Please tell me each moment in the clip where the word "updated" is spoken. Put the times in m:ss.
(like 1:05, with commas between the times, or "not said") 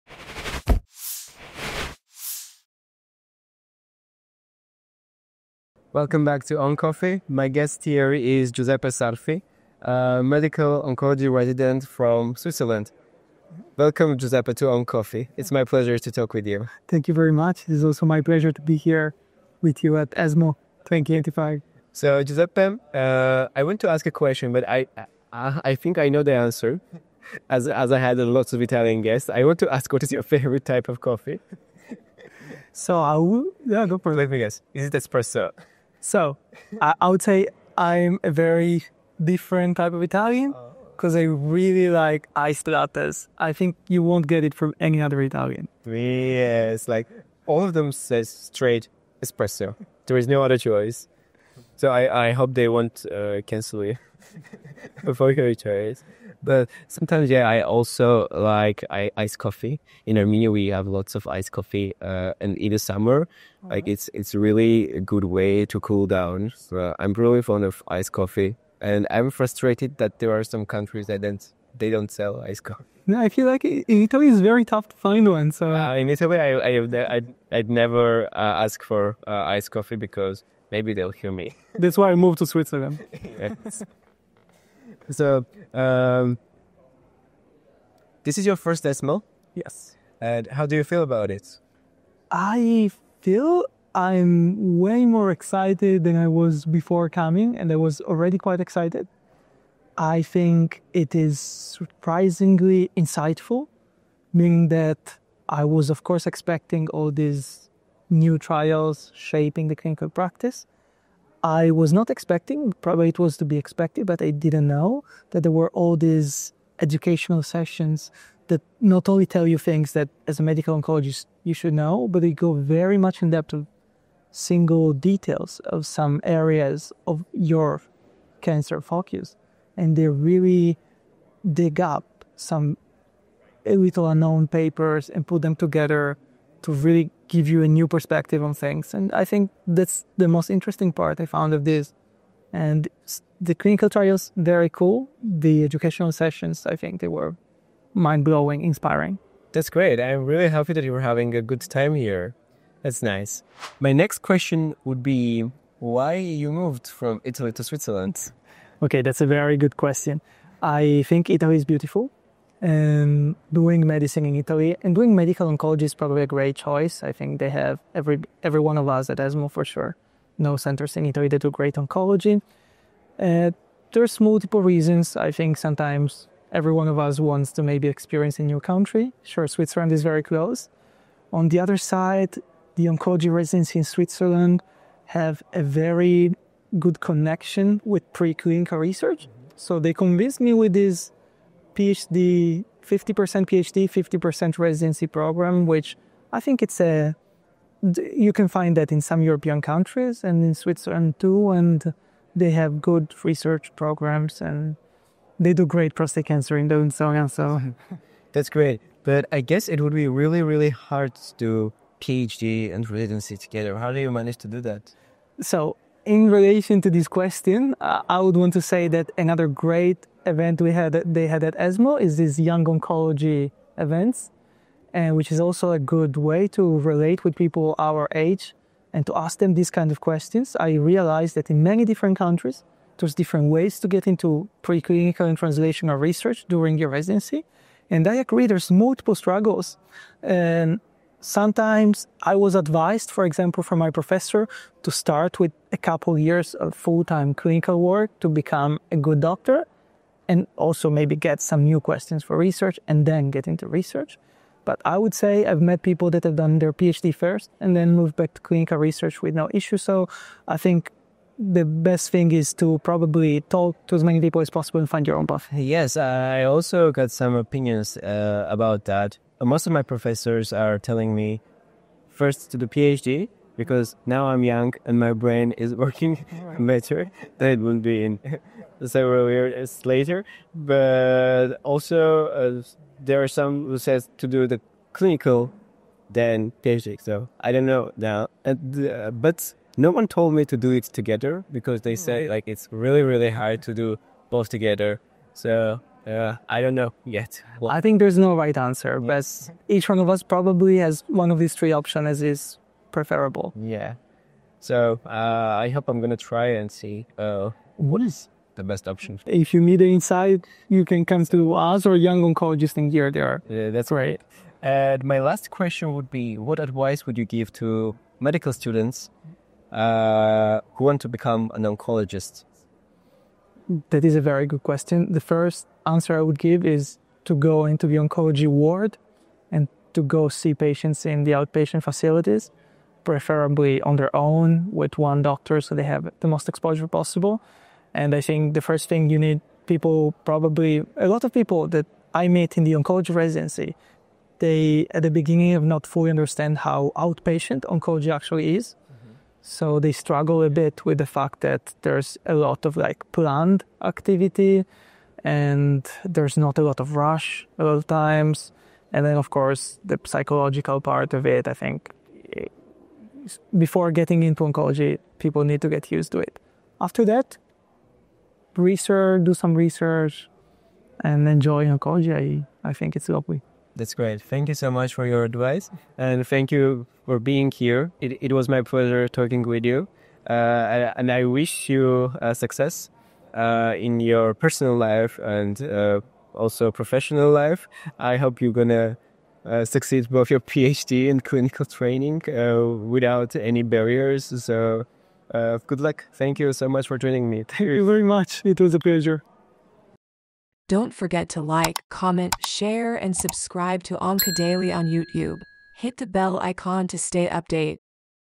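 6:47.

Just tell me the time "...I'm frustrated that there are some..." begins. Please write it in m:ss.
1:09.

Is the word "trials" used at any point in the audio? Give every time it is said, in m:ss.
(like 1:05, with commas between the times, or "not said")
1:48, 2:23.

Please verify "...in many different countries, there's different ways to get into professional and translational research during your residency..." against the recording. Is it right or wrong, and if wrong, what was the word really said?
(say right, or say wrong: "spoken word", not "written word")
wrong: "preclinical", not "professional".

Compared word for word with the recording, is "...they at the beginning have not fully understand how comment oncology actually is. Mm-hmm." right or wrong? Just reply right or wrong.
wrong.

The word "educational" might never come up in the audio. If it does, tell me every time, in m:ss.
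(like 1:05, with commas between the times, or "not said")
1:56, 2:25.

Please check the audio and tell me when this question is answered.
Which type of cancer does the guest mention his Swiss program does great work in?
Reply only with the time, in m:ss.
3:25.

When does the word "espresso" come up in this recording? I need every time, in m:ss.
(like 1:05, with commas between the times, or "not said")
0:34, 0:49.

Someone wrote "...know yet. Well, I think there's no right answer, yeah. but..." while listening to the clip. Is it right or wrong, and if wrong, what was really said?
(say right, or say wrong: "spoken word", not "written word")
right.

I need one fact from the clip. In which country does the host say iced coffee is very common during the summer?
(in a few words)
Armenia.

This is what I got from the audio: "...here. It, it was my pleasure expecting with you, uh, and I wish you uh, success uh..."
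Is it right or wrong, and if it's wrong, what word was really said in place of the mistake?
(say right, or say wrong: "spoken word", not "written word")
wrong: "talking", not "expecting".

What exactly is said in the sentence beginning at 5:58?
And then of course the psychological part of it, I think before getting into oncology, people need to get used to it.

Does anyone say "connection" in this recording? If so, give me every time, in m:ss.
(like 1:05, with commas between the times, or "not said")
3:06.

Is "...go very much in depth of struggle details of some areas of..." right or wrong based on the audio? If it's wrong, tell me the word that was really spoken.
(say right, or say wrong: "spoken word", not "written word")
wrong: "single", not "struggle".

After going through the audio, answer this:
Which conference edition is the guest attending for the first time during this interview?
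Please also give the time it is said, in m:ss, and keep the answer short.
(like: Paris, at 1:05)
ESMO 2025, at 0:20.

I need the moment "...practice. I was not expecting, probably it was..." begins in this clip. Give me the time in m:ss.
1:50.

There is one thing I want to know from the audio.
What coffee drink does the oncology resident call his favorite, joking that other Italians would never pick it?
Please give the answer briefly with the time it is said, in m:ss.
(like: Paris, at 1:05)
Iced lattes, at 0:42.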